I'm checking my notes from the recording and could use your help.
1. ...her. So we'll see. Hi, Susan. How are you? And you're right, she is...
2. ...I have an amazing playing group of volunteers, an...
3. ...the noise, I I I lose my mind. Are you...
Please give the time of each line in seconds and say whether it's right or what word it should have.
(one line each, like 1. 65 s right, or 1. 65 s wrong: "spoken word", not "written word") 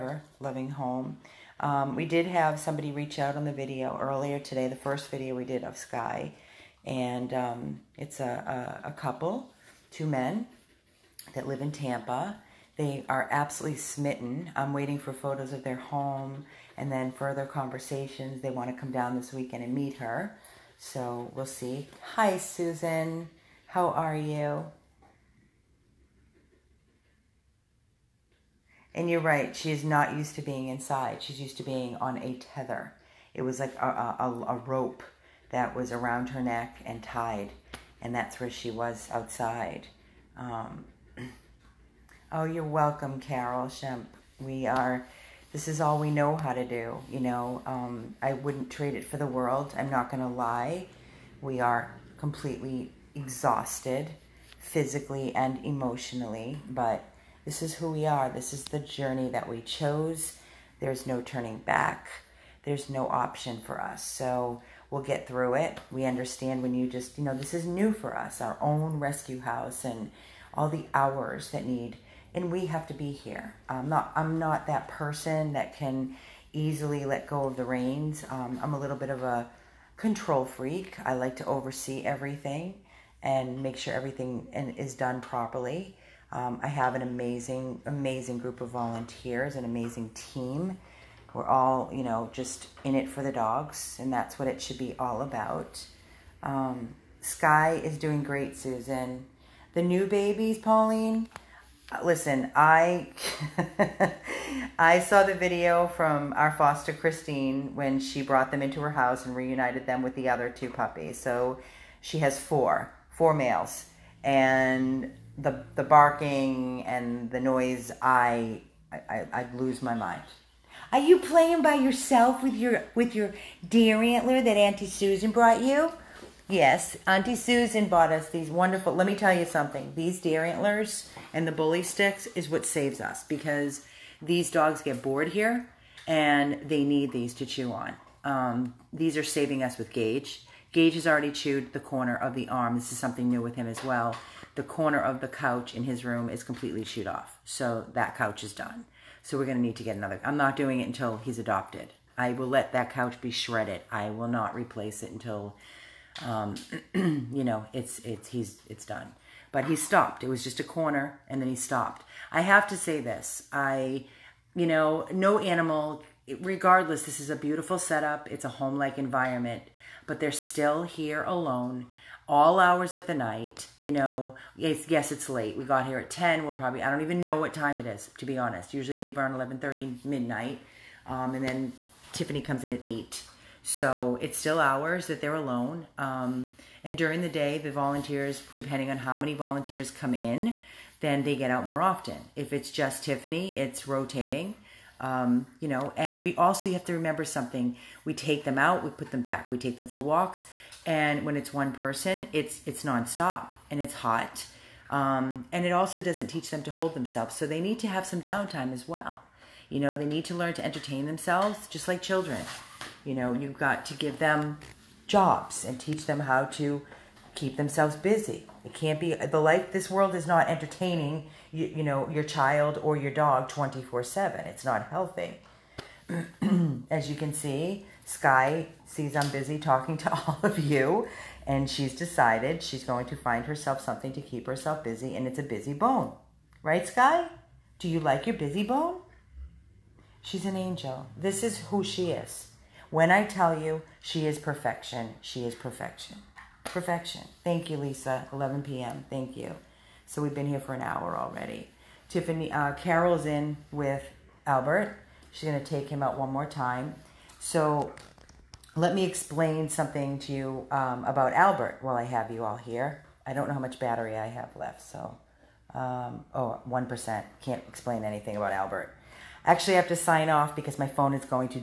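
1. 19 s right
2. 86 s wrong: "amazing", not "playing"
3. 117 s right.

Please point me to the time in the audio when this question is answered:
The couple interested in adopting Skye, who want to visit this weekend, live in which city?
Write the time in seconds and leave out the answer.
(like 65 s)
11 s.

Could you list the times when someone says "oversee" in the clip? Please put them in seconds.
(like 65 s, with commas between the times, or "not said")
81 s.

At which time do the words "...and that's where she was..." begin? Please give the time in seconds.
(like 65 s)
38 s.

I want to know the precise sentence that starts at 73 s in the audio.
I'm not I'm not that person that can easily let go of the reins.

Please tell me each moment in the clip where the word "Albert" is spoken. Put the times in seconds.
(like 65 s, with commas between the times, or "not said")
254 s, 261 s, 268 s.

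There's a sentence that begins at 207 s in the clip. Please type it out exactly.
So they need to have some downtime as well.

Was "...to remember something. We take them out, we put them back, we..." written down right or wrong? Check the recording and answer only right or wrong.
right.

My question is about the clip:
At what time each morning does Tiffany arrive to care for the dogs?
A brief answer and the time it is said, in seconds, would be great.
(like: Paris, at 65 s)
8, at 182 s.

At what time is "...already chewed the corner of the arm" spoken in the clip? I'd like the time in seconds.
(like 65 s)
141 s.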